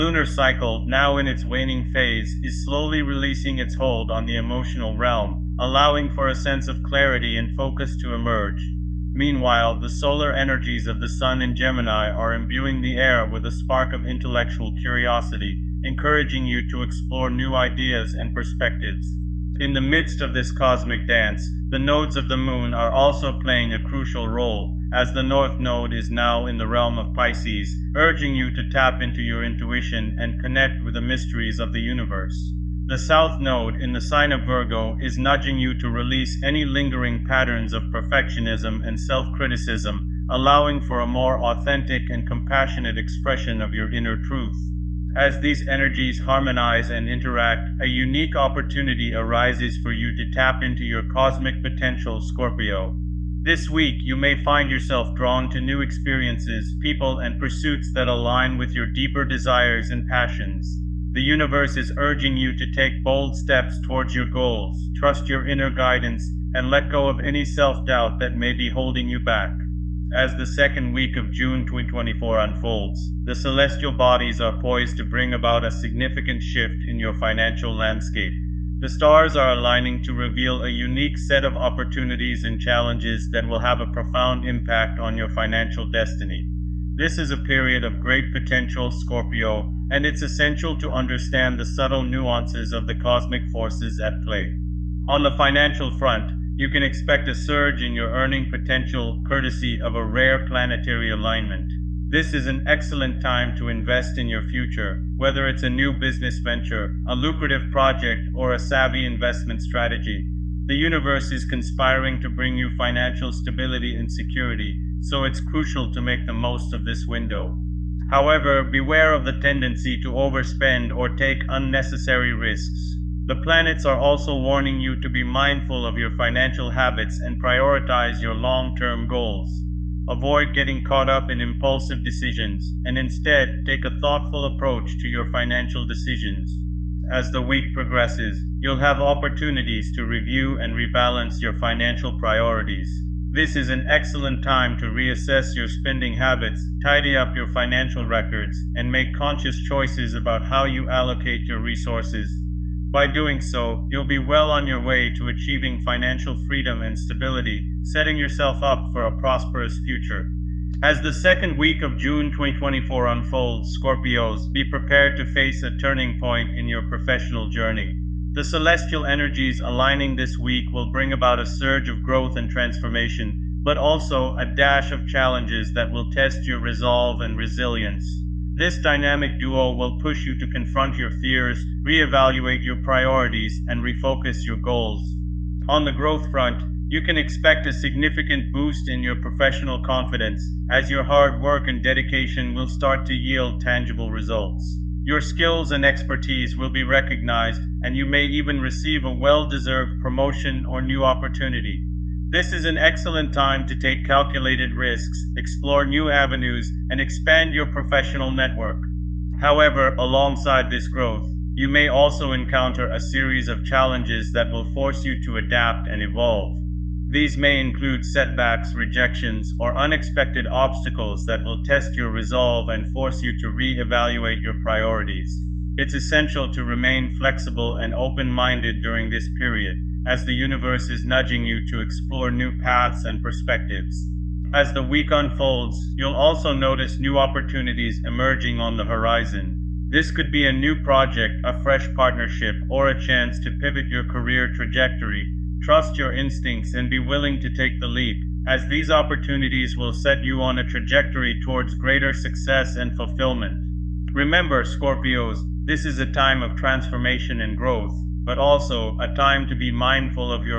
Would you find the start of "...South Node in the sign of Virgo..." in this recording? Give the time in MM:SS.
00:32.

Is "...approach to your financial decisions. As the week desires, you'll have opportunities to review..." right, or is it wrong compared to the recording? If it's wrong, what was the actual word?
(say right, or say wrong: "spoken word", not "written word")
wrong: "progresses", not "desires".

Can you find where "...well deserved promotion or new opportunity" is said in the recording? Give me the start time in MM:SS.
03:19.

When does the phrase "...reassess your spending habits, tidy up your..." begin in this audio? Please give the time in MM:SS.
02:24.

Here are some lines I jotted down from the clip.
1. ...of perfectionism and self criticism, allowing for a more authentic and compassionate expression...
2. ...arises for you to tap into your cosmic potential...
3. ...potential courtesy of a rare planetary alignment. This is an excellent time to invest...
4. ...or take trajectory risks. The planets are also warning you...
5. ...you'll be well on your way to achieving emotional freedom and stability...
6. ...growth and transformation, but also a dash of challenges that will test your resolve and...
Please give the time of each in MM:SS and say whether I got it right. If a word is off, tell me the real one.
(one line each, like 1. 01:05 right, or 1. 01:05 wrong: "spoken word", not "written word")
1. 00:37 right
2. 00:49 right
3. 01:38 right
4. 02:00 wrong: "unnecessary", not "trajectory"
5. 02:33 wrong: "financial", not "emotional"
6. 02:52 right.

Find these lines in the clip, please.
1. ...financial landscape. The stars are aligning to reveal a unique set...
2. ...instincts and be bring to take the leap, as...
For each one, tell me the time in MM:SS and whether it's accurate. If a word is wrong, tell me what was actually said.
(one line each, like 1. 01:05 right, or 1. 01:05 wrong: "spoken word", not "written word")
1. 01:17 right
2. 04:06 wrong: "willing", not "bring".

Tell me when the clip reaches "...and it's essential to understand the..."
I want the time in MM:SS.
01:29.